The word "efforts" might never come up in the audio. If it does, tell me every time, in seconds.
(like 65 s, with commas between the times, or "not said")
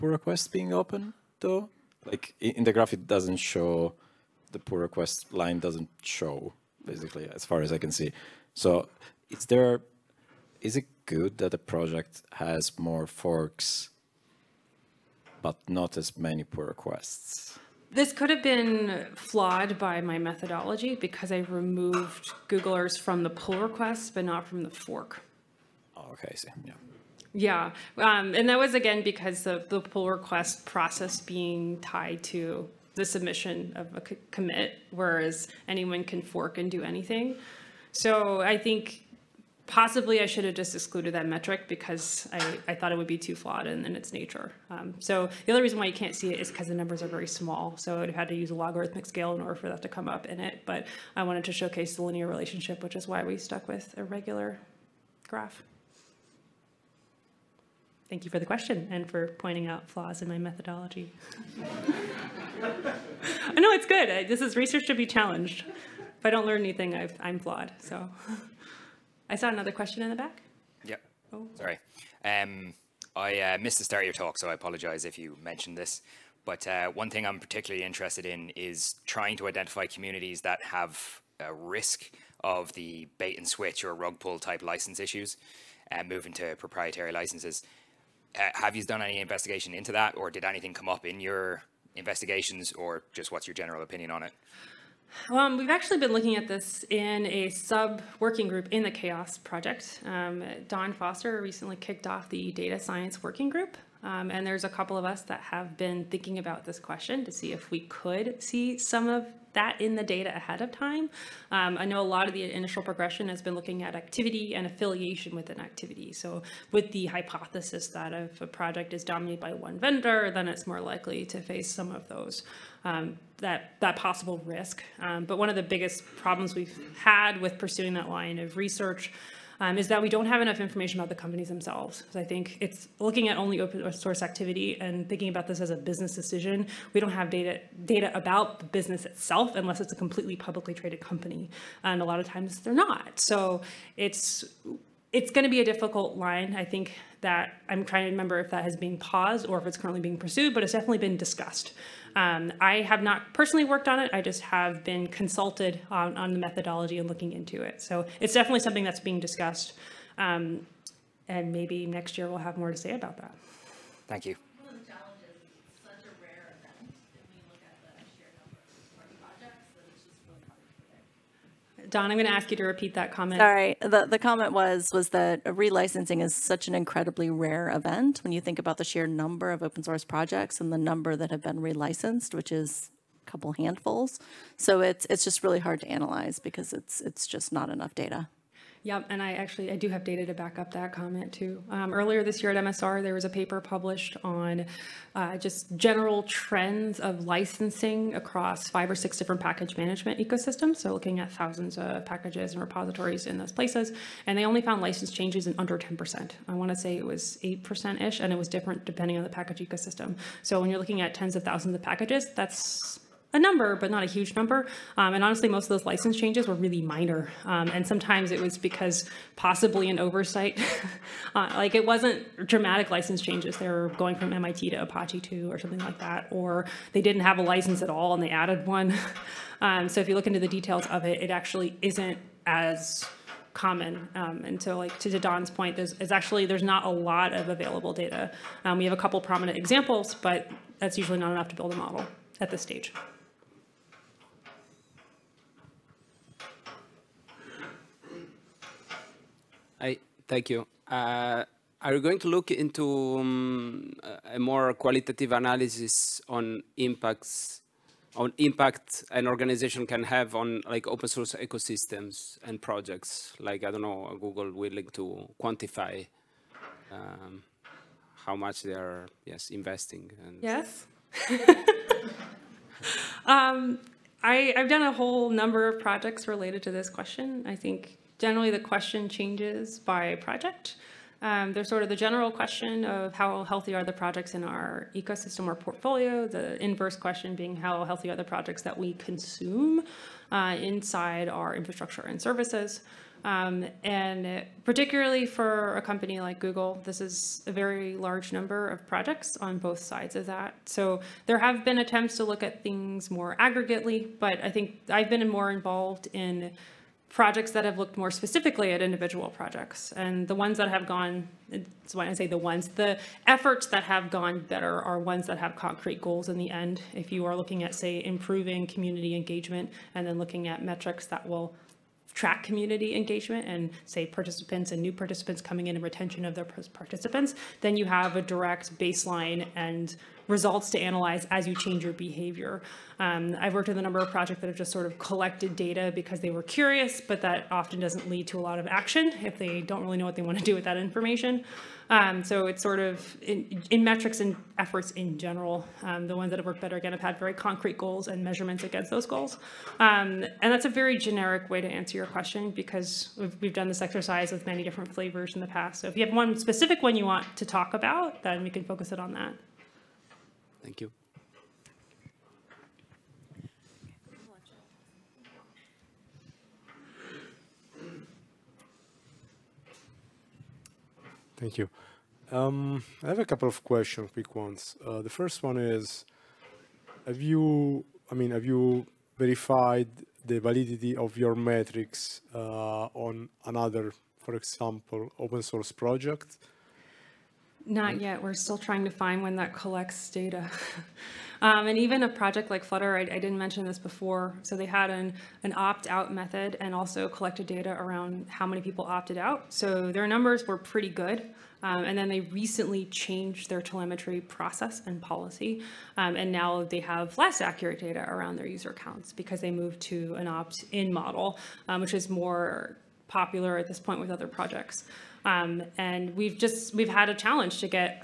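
313 s, 344 s.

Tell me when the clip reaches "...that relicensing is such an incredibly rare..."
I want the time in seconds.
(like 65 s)
175 s.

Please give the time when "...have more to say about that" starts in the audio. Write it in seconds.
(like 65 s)
162 s.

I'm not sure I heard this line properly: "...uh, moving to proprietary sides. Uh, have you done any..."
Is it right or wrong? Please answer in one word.
wrong.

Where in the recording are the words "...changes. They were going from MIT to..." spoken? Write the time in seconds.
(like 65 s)
223 s.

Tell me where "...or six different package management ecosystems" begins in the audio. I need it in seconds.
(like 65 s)
198 s.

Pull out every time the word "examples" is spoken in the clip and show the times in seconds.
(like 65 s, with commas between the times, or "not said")
239 s, 384 s.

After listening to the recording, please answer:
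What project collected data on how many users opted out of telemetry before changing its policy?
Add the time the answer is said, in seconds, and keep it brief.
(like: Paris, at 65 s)
Flutter, at 392 s.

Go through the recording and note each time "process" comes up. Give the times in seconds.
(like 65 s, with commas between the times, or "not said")
30 s, 404 s.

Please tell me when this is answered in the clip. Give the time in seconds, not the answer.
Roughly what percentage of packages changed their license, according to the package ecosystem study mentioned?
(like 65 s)
207 s.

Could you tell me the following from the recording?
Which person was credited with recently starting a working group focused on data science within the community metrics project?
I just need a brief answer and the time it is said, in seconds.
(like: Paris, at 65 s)
Dawn Foster, at 100 s.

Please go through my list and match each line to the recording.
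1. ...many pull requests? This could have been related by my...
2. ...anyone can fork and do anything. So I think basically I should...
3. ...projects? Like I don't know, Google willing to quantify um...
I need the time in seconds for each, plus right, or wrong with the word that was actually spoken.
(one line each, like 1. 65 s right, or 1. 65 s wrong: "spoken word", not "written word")
1. 16 s wrong: "flawed", not "related"
2. 35 s wrong: "possibly", not "basically"
3. 262 s right.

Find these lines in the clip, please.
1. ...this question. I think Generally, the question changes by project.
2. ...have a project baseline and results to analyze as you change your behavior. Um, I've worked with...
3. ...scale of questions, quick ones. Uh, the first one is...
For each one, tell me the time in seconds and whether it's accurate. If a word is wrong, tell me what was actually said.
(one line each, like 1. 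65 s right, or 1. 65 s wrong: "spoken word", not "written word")
1. 276 s right
2. 327 s wrong: "direct", not "project"
3. 373 s wrong: "couple", not "scale".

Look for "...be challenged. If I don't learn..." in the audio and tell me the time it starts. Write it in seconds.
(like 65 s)
64 s.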